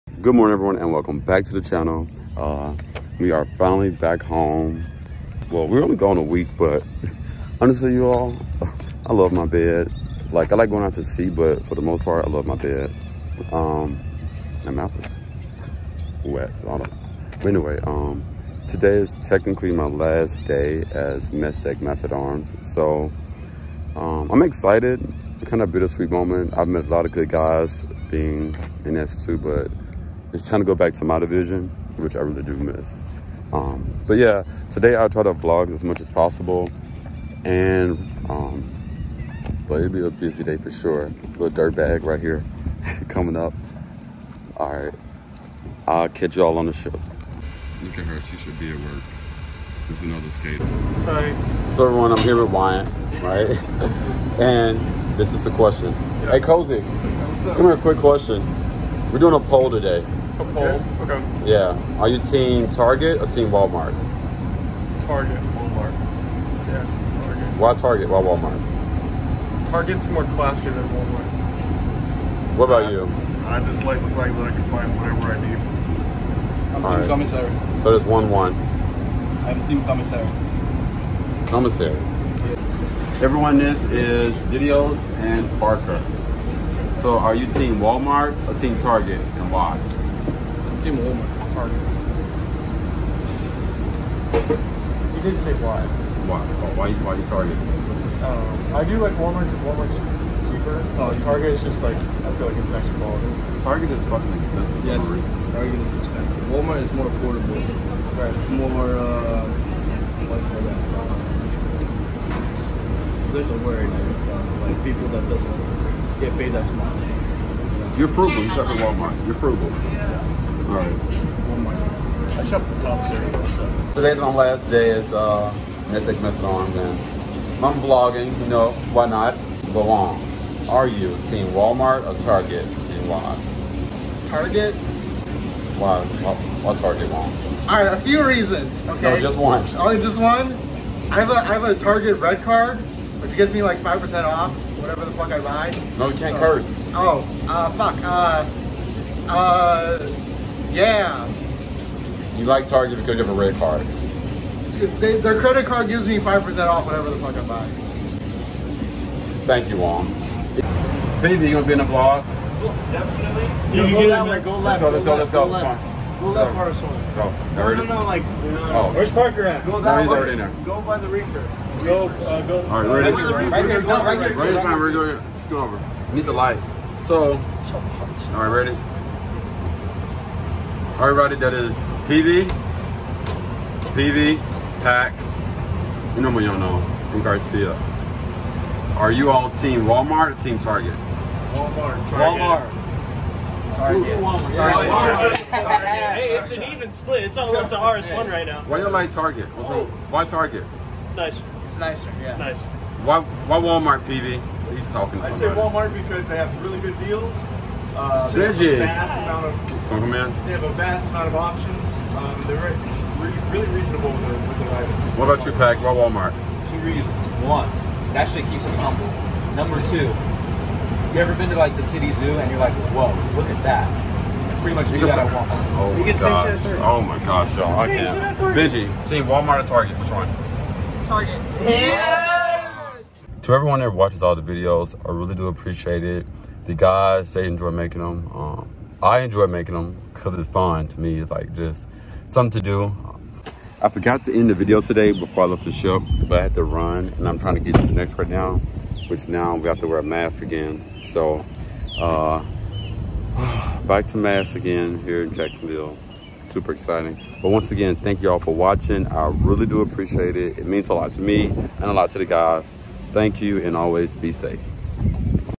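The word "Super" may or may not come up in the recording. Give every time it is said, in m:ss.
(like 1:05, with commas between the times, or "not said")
4:16.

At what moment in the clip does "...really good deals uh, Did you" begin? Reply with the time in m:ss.
3:26.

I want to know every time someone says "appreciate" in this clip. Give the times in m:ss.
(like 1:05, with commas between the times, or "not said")
3:55, 4:19.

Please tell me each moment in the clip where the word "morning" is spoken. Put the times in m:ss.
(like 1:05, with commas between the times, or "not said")
0:00.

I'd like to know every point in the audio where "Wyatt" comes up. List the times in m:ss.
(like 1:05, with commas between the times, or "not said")
0:52.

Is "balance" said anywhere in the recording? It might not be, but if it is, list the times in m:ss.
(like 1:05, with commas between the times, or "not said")
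not said.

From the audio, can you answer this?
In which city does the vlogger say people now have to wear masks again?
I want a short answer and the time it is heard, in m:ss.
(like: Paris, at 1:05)
Jacksonville, at 4:15.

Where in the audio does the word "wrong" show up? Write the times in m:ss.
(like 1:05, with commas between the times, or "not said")
2:17, 3:19.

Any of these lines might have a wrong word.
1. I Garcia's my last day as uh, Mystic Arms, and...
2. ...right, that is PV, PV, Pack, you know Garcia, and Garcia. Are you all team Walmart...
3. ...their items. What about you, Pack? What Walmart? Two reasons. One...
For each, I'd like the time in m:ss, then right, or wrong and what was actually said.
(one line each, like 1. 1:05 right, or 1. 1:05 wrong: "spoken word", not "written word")
1. 2:00 wrong: "Today", not "Garcia"
2. 3:01 wrong: "Unomoyono", not "Garcia"
3. 3:34 right.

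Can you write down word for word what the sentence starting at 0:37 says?
And, um, but it'll be a busy day for sure.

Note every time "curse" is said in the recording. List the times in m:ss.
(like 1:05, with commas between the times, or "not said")
2:26.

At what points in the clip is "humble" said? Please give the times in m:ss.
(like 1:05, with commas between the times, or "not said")
3:38.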